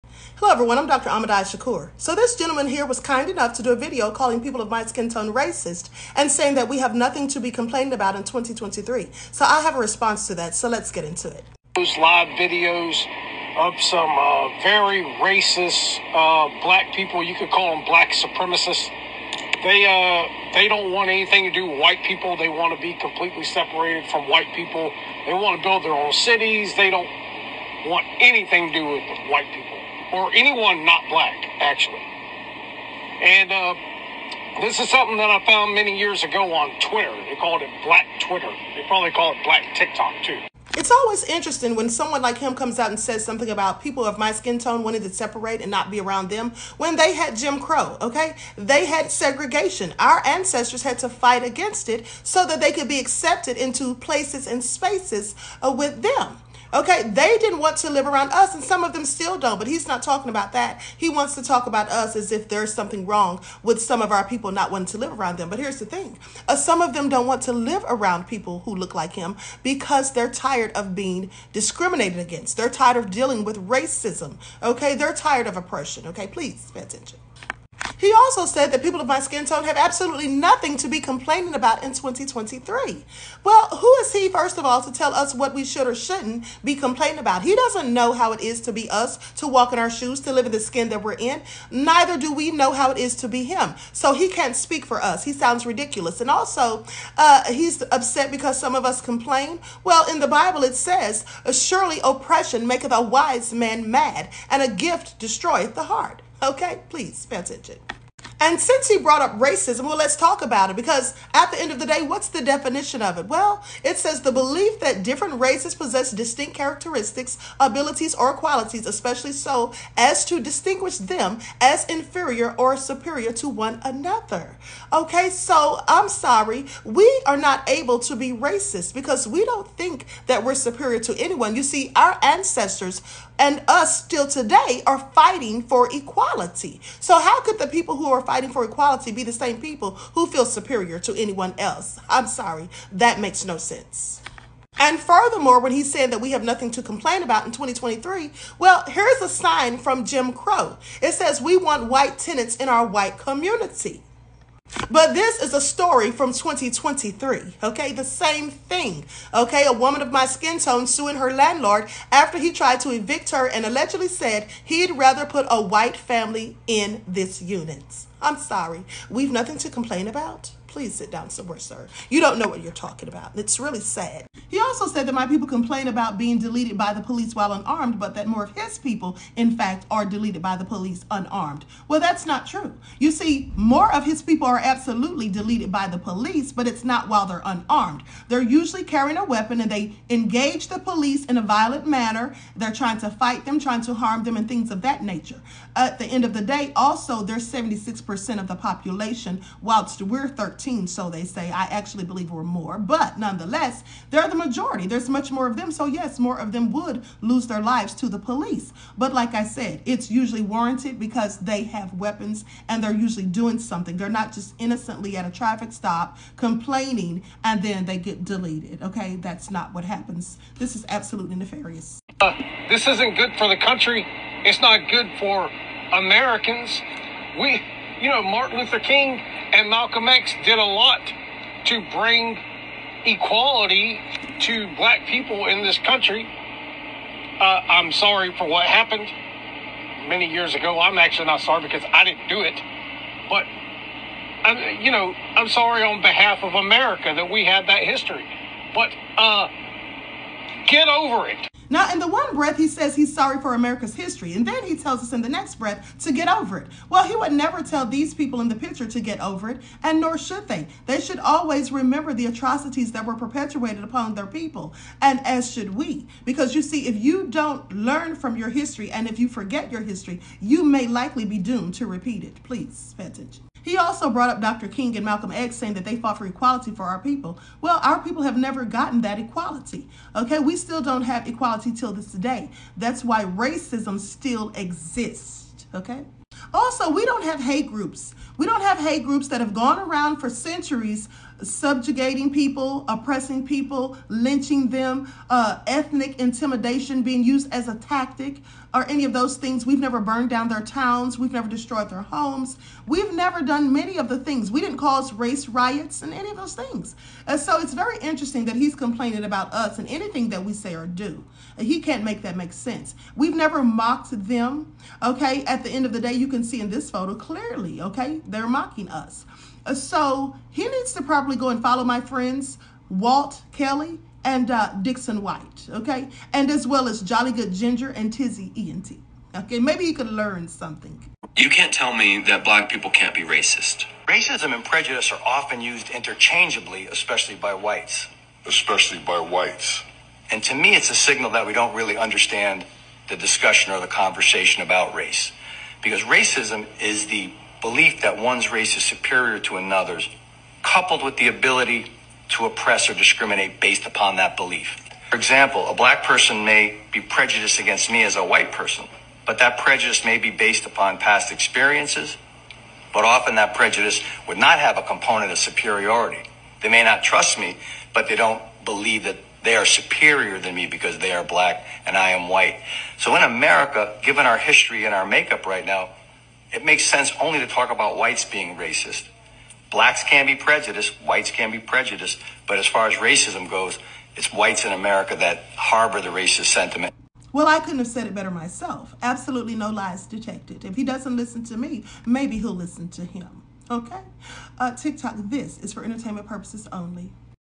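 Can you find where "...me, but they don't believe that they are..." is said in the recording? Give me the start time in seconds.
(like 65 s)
367 s.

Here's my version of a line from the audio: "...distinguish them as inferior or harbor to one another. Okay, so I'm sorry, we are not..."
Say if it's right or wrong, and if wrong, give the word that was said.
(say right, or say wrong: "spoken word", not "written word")
wrong: "superior", not "harbor".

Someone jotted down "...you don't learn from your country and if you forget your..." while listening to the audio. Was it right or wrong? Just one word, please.
wrong.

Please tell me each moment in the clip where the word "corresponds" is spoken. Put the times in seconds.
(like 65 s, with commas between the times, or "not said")
not said.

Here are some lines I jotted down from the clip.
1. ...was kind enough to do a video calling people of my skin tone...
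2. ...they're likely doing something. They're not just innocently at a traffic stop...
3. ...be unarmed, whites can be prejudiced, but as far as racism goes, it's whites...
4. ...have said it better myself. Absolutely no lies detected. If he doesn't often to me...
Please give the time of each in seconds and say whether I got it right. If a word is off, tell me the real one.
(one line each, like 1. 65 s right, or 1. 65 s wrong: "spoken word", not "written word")
1. 2 s right
2. 212 s wrong: "usually", not "likely"
3. 380 s wrong: "prejudiced", not "unarmed"
4. 387 s wrong: "listen", not "often".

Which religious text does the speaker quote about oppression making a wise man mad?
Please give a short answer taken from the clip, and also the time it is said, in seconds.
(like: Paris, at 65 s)
The Bible, at 100 s.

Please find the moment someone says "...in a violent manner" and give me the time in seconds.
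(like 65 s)
191 s.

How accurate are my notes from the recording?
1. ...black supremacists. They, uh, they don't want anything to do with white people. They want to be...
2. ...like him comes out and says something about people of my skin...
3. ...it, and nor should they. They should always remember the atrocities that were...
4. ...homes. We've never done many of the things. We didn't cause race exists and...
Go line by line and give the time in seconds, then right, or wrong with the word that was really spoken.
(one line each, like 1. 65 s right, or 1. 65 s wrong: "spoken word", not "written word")
1. 17 s right
2. 42 s right
3. 259 s right
4. 302 s wrong: "riots", not "exists".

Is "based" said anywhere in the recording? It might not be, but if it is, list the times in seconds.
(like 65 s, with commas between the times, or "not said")
353 s, 360 s.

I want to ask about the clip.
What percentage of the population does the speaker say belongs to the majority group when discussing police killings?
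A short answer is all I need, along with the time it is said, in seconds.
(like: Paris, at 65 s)
76%, at 197 s.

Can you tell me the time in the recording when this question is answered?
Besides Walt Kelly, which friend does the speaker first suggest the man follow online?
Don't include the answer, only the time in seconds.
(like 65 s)
324 s.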